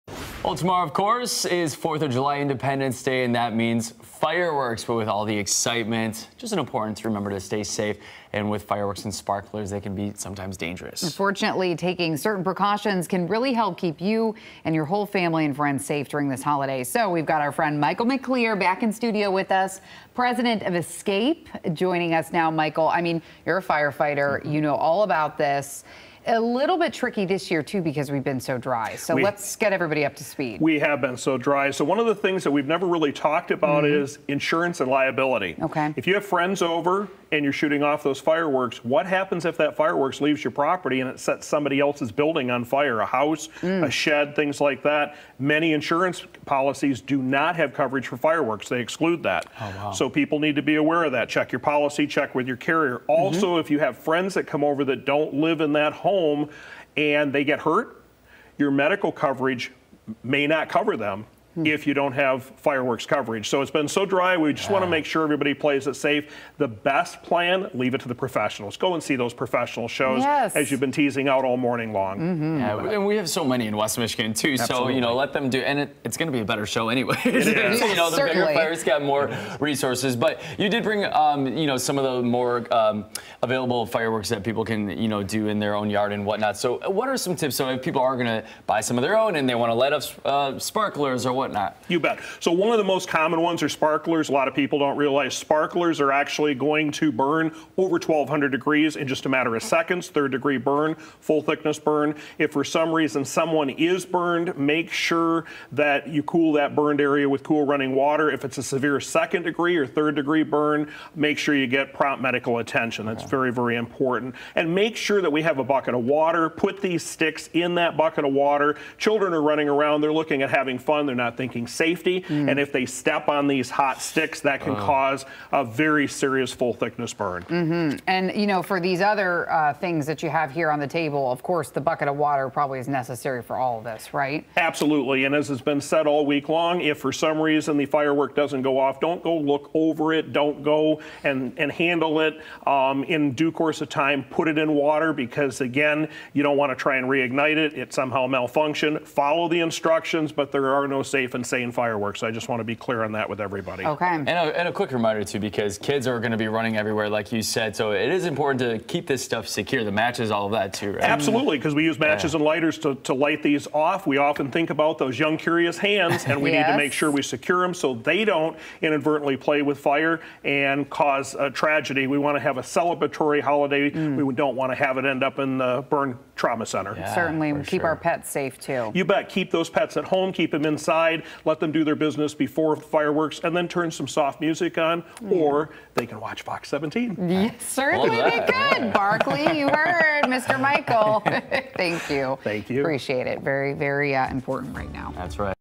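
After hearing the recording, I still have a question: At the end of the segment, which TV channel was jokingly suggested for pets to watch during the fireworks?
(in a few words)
Fox 17.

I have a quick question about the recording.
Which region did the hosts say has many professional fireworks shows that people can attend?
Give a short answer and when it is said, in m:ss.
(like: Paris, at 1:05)
West Michigan, at 1:13.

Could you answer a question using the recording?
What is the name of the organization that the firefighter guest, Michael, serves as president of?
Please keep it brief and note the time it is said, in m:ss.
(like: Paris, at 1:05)
Escape, at 0:20.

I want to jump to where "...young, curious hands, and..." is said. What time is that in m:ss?
2:45.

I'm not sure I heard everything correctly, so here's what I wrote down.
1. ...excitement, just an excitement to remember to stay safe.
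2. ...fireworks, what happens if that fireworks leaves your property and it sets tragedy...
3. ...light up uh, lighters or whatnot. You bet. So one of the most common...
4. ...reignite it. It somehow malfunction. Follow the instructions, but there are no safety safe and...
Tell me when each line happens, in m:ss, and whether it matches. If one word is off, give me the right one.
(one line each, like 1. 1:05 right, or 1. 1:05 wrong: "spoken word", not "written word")
1. 0:05 wrong: "important", not "excitement"
2. 0:38 wrong: "somebody", not "tragedy"
3. 1:29 wrong: "sparklers", not "lighters"
4. 2:27 right.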